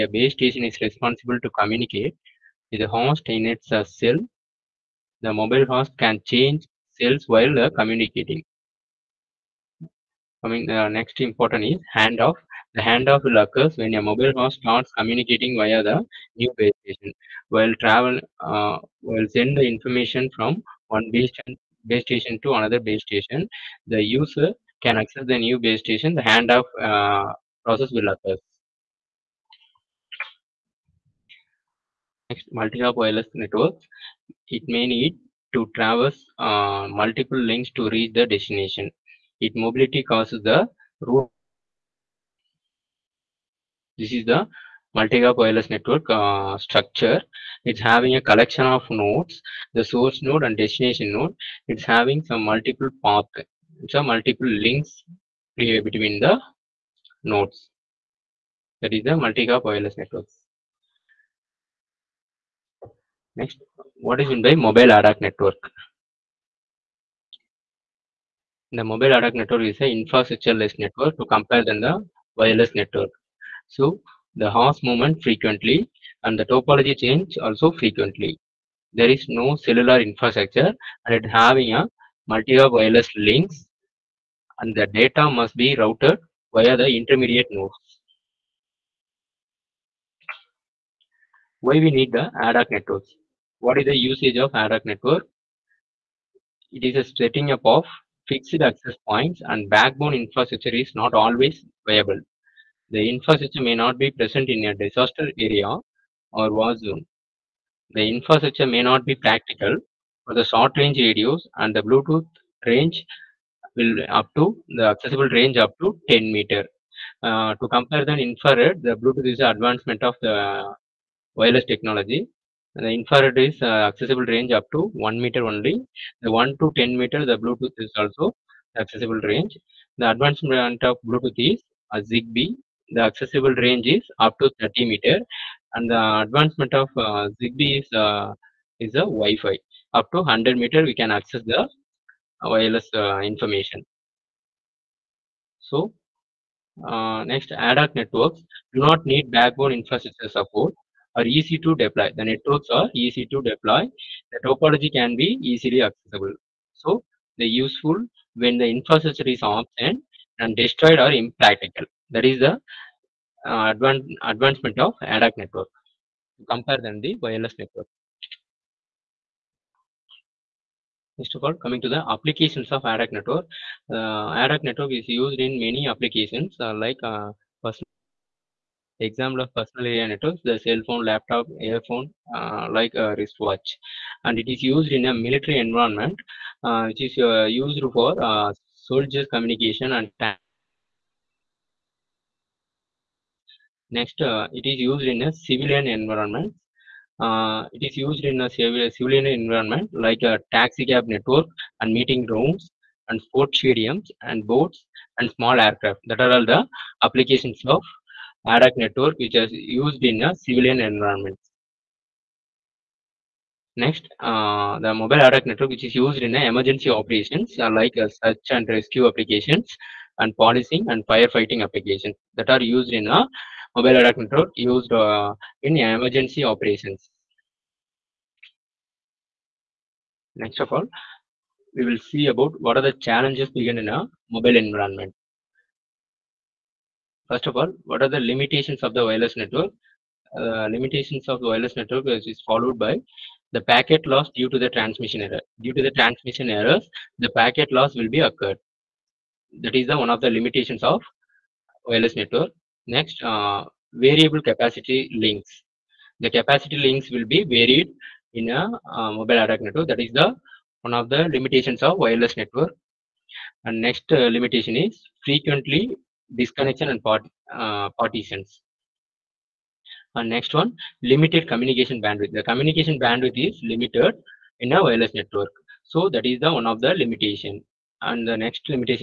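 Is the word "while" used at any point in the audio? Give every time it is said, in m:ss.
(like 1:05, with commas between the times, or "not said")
0:07, 0:17.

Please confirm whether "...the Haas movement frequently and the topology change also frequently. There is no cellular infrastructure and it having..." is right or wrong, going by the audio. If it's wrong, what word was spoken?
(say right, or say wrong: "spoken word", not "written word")
right.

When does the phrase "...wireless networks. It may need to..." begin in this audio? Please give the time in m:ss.
0:32.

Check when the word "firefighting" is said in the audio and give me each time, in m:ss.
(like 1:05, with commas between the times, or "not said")
3:41.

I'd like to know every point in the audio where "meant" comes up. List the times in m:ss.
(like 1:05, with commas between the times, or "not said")
1:04.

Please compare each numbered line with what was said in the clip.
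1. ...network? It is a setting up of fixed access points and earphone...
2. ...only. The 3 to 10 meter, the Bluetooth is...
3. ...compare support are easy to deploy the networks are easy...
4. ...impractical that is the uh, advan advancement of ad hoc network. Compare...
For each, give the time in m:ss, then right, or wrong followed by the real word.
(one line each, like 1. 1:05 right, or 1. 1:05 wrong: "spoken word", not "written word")
1. 1:34 wrong: "backbone", not "earphone"
2. 2:05 wrong: "1", not "3"
3. 2:29 wrong: "infrastructure", not "compare"
4. 2:41 right.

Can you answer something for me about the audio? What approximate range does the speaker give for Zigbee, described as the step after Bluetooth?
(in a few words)
30 meters.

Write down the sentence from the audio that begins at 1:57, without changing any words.
Uh, to compare the infrared, the Bluetooth is advancement of the wireless technology.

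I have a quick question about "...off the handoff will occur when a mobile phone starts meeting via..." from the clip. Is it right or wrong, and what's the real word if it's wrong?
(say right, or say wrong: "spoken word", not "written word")
wrong: "communicating", not "meeting".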